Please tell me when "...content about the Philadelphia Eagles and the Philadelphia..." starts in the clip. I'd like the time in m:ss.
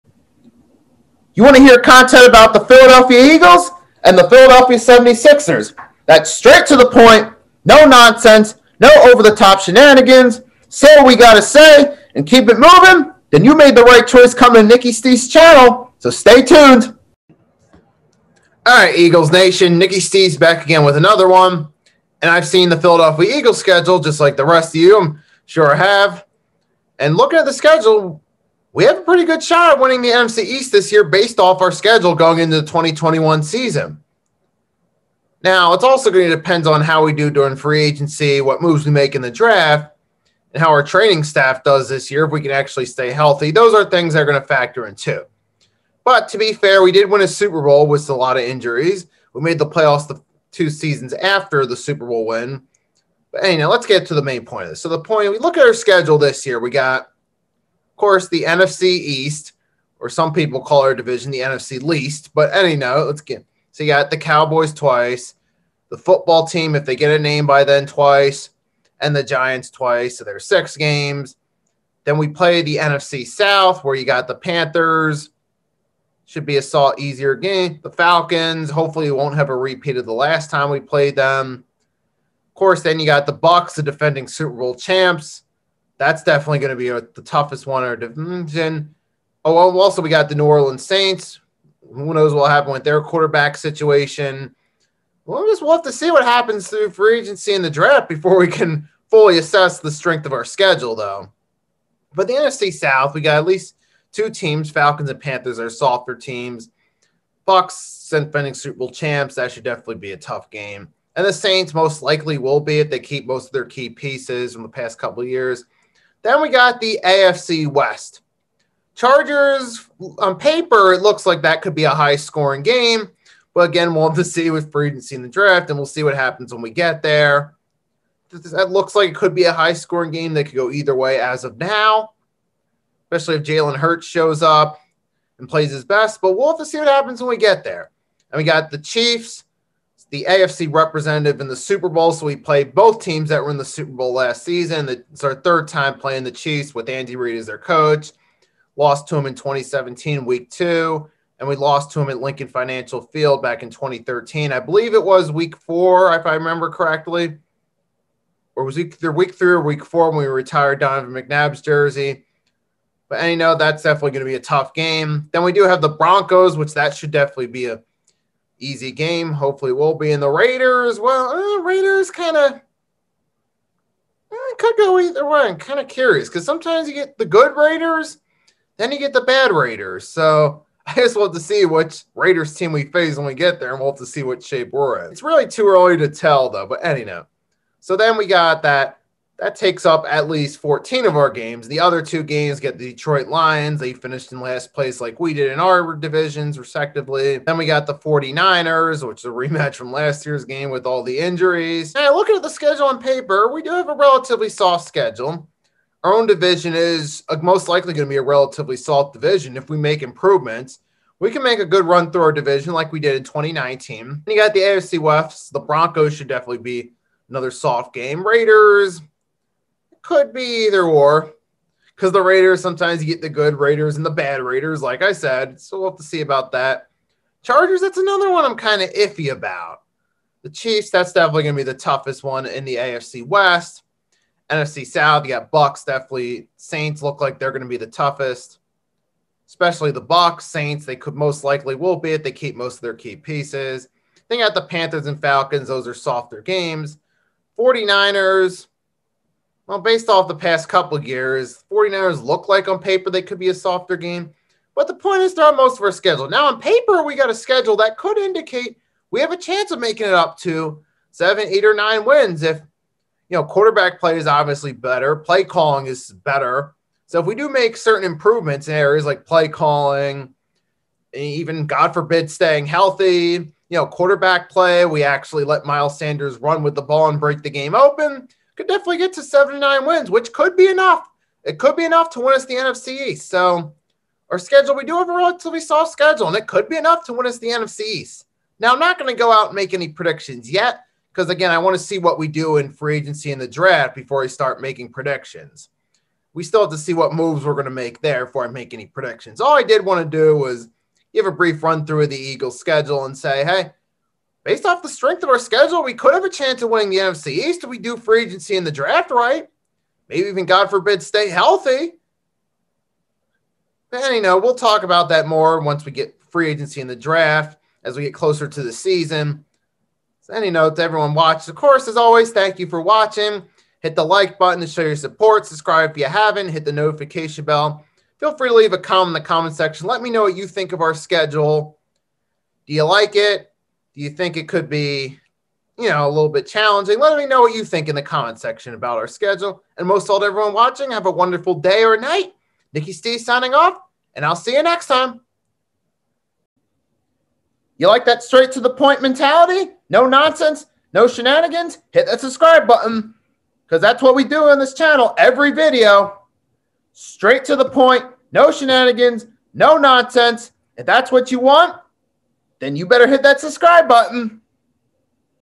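0:01.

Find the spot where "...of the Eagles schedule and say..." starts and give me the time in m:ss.
5:02.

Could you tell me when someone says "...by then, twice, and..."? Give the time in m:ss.
1:07.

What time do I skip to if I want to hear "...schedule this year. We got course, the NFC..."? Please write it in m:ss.
0:55.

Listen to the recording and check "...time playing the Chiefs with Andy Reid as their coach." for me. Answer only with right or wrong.
right.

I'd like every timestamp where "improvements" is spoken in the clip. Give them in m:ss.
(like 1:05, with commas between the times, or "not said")
3:30, 4:28.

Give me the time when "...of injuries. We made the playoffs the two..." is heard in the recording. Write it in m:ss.
0:48.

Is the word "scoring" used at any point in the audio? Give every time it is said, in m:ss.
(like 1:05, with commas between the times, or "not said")
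2:02, 2:09.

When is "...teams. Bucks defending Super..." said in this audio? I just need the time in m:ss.
1:46.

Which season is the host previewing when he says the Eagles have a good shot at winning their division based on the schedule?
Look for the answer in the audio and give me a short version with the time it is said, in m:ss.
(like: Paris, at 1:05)
2021, at 0:32.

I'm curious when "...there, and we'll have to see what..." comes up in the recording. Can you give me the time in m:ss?
3:03.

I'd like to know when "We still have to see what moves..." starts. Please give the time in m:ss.
4:56.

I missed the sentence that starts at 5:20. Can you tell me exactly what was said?
So, any notes, to everyone watched, of course, as always, thank you for watching.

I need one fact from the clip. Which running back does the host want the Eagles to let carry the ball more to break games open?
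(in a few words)
Miles Sanders.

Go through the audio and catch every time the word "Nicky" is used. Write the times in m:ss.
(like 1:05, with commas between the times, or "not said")
0:14, 0:19, 5:42.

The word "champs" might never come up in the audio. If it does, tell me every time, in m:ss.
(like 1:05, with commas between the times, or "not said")
1:24, 1:48.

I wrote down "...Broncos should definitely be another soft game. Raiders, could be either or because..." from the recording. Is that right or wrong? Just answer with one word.
right.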